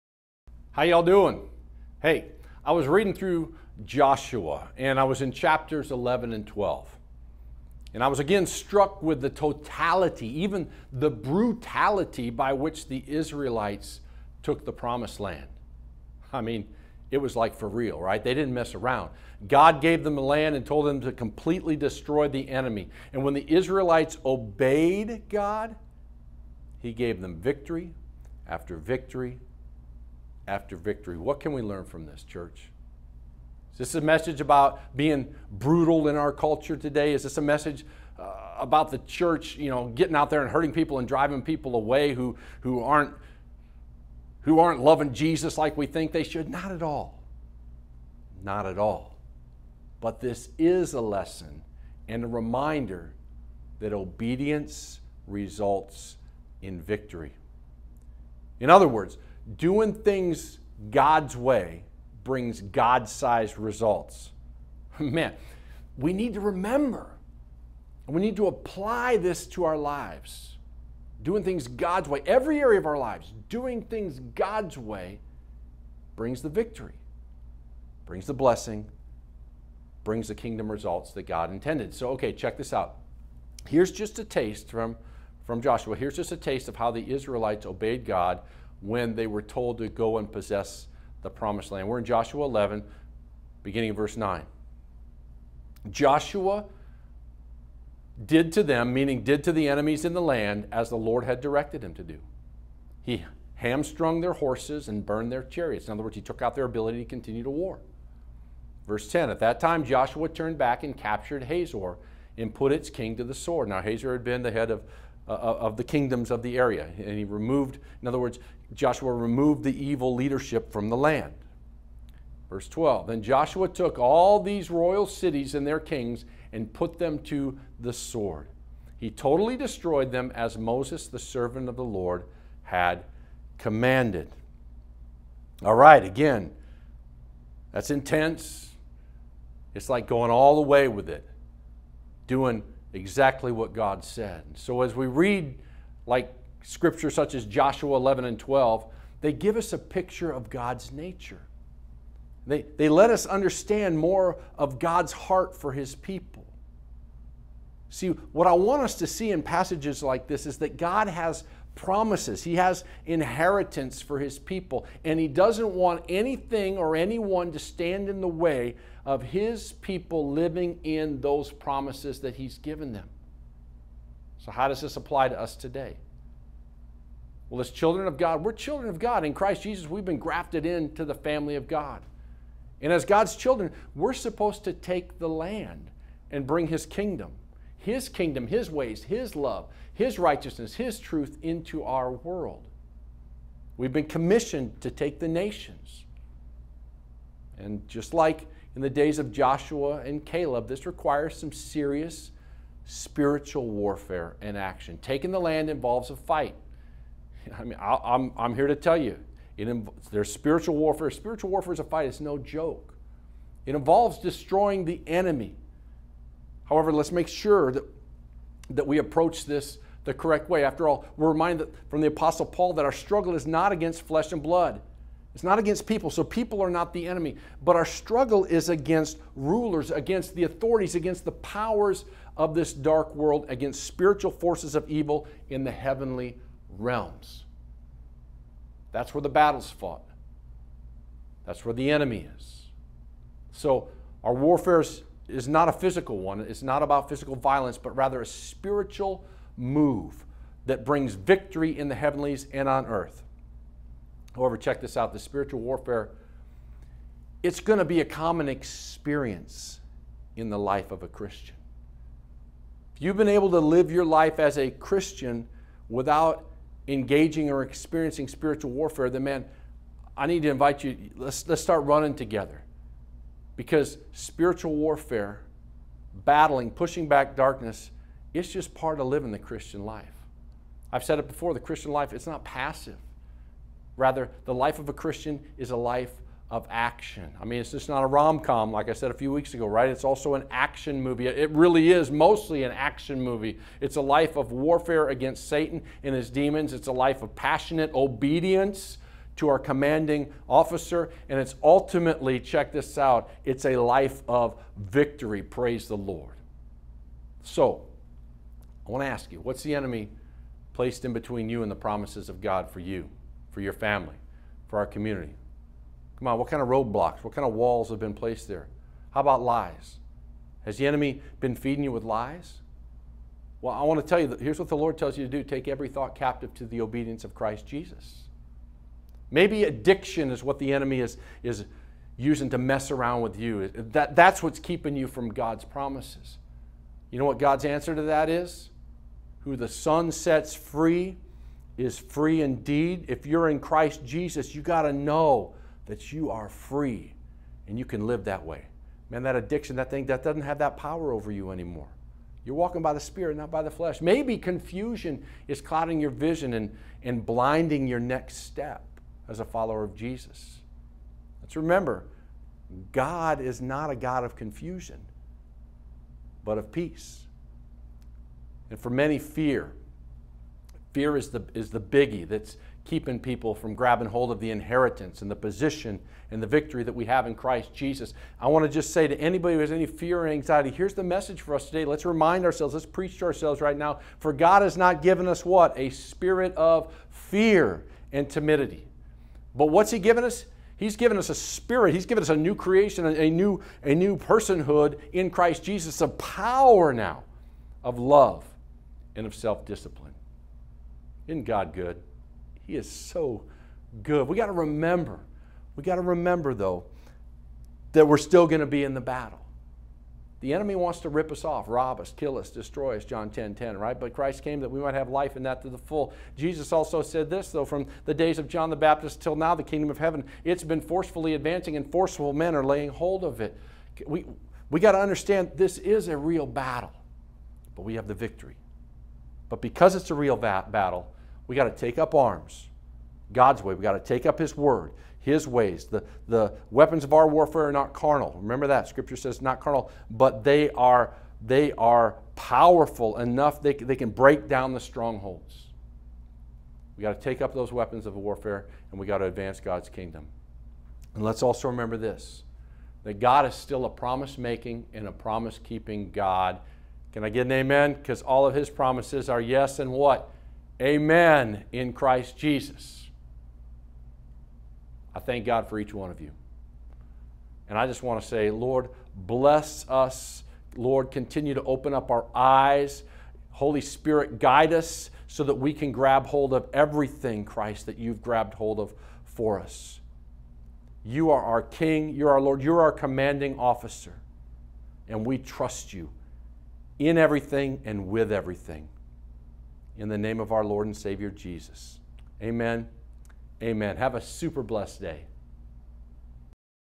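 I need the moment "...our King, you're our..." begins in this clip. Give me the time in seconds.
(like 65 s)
481 s.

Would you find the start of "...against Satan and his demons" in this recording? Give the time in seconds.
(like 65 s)
295 s.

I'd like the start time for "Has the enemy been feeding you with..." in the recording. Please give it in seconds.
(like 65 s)
320 s.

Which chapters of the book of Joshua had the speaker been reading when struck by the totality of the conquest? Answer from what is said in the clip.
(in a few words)
11 and 12.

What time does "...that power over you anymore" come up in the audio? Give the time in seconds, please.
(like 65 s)
350 s.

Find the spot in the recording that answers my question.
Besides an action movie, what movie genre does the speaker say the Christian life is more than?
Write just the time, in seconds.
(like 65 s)
288 s.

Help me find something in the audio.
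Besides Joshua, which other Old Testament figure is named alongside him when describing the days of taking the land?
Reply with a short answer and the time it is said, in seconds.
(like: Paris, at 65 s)
Caleb, at 200 s.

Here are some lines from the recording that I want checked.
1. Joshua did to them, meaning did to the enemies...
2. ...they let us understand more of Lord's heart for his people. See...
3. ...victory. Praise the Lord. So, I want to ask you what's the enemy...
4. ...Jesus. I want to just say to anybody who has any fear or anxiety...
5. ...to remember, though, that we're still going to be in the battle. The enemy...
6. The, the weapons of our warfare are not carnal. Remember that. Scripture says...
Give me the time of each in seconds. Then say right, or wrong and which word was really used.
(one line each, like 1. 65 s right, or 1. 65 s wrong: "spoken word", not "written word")
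1. 95 s right
2. 152 s wrong: "God", not "Lord"
3. 304 s right
4. 377 s right
5. 405 s right
6. 435 s right.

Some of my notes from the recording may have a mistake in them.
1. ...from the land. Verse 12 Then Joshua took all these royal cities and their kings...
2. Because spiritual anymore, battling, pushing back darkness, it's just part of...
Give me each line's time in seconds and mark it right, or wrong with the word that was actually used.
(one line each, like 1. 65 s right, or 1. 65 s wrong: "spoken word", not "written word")
1. 120 s right
2. 273 s wrong: "warfare", not "anymore".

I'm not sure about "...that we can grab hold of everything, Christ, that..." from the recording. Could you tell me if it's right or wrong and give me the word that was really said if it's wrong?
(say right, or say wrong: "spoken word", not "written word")
right.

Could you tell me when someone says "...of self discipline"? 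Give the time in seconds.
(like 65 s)
399 s.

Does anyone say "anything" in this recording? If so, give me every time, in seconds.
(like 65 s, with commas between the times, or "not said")
166 s.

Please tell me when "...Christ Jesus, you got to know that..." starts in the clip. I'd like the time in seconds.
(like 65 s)
343 s.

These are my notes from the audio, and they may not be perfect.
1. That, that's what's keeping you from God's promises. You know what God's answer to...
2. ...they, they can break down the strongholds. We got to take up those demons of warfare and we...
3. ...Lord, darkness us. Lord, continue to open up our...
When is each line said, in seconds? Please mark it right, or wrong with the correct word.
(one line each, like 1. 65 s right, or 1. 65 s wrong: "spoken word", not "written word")
1. 333 s right
2. 443 s wrong: "weapons", not "demons"
3. 468 s wrong: "bless", not "darkness".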